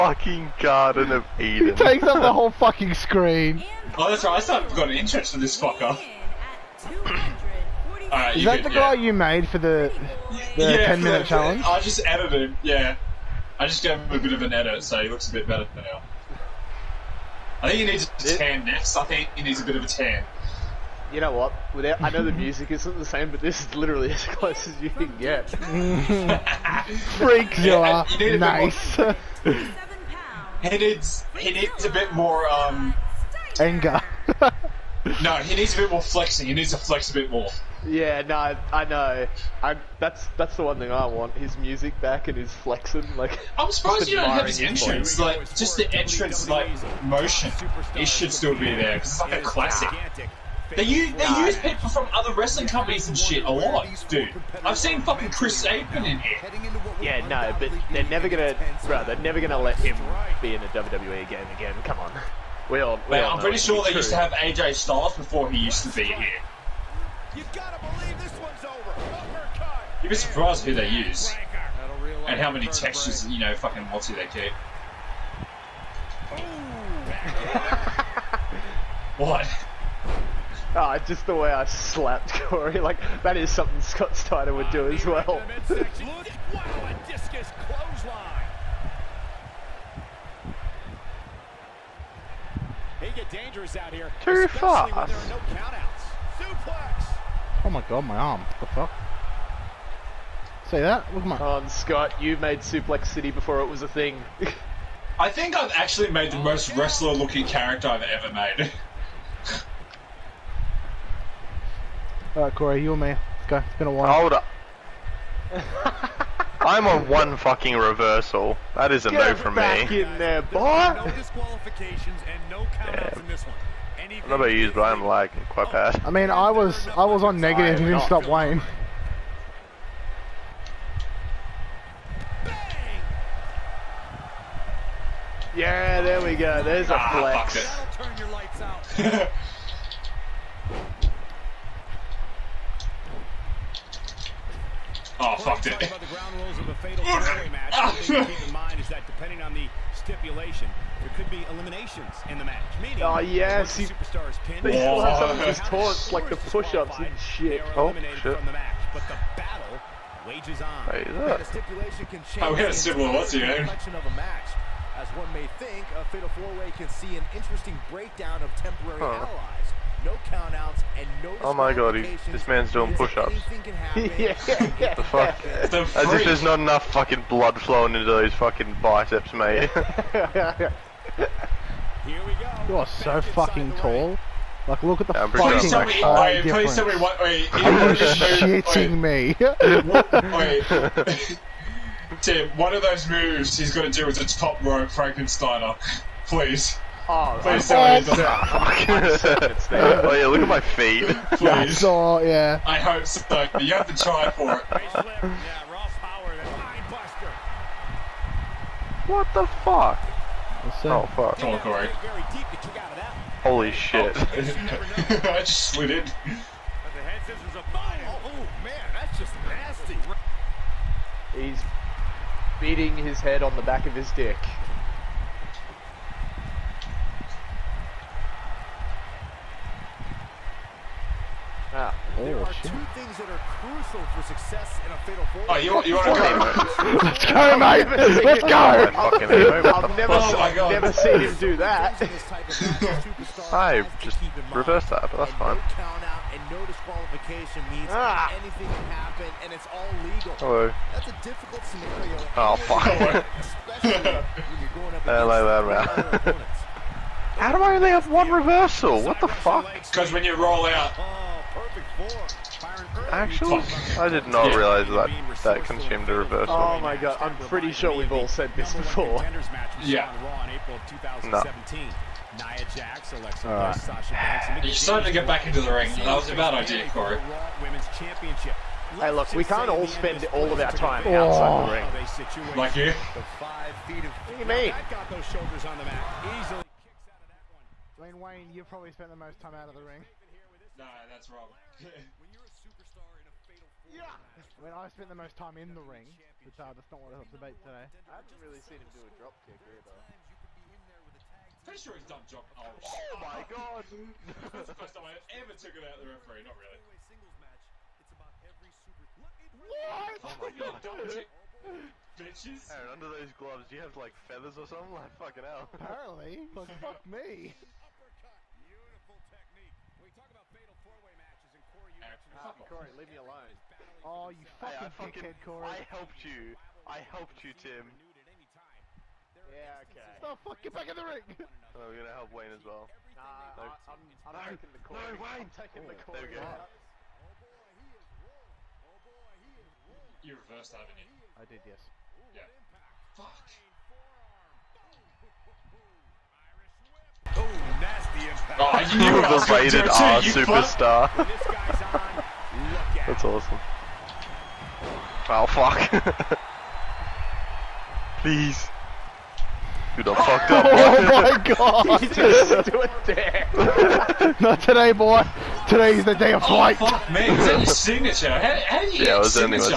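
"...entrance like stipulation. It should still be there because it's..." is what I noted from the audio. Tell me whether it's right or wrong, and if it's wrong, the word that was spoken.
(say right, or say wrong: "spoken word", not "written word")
wrong: "motion", not "stipulation".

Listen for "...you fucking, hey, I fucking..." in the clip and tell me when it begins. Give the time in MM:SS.
05:24.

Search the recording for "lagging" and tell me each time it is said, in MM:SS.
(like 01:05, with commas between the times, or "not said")
02:05.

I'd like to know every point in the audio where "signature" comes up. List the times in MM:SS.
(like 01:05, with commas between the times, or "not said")
06:07.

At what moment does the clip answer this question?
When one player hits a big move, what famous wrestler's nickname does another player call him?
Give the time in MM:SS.
05:49.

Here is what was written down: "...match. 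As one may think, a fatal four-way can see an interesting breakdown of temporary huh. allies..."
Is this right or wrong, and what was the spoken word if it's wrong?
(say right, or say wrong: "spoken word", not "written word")
right.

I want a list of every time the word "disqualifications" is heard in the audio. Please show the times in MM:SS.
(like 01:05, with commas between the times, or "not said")
02:01, 04:06.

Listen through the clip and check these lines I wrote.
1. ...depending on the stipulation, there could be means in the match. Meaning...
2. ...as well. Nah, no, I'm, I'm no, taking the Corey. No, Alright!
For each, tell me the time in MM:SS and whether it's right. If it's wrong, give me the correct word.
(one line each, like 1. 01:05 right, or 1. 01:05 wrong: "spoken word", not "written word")
1. 02:29 wrong: "eliminations", not "means"
2. 05:32 wrong: "Wayne", not "Alright".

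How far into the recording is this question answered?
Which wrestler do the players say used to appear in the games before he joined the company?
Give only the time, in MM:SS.
01:04.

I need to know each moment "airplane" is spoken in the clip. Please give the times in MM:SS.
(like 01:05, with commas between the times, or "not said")
not said.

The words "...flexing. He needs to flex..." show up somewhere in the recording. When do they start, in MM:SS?
00:36.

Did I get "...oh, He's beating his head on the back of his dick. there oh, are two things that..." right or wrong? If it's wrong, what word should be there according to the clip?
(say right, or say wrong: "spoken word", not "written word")
right.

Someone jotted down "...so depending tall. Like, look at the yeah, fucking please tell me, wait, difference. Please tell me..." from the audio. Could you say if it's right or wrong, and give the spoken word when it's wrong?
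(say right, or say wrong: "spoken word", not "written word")
wrong: "fucking", not "depending".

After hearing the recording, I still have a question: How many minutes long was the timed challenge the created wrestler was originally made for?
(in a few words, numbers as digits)
10.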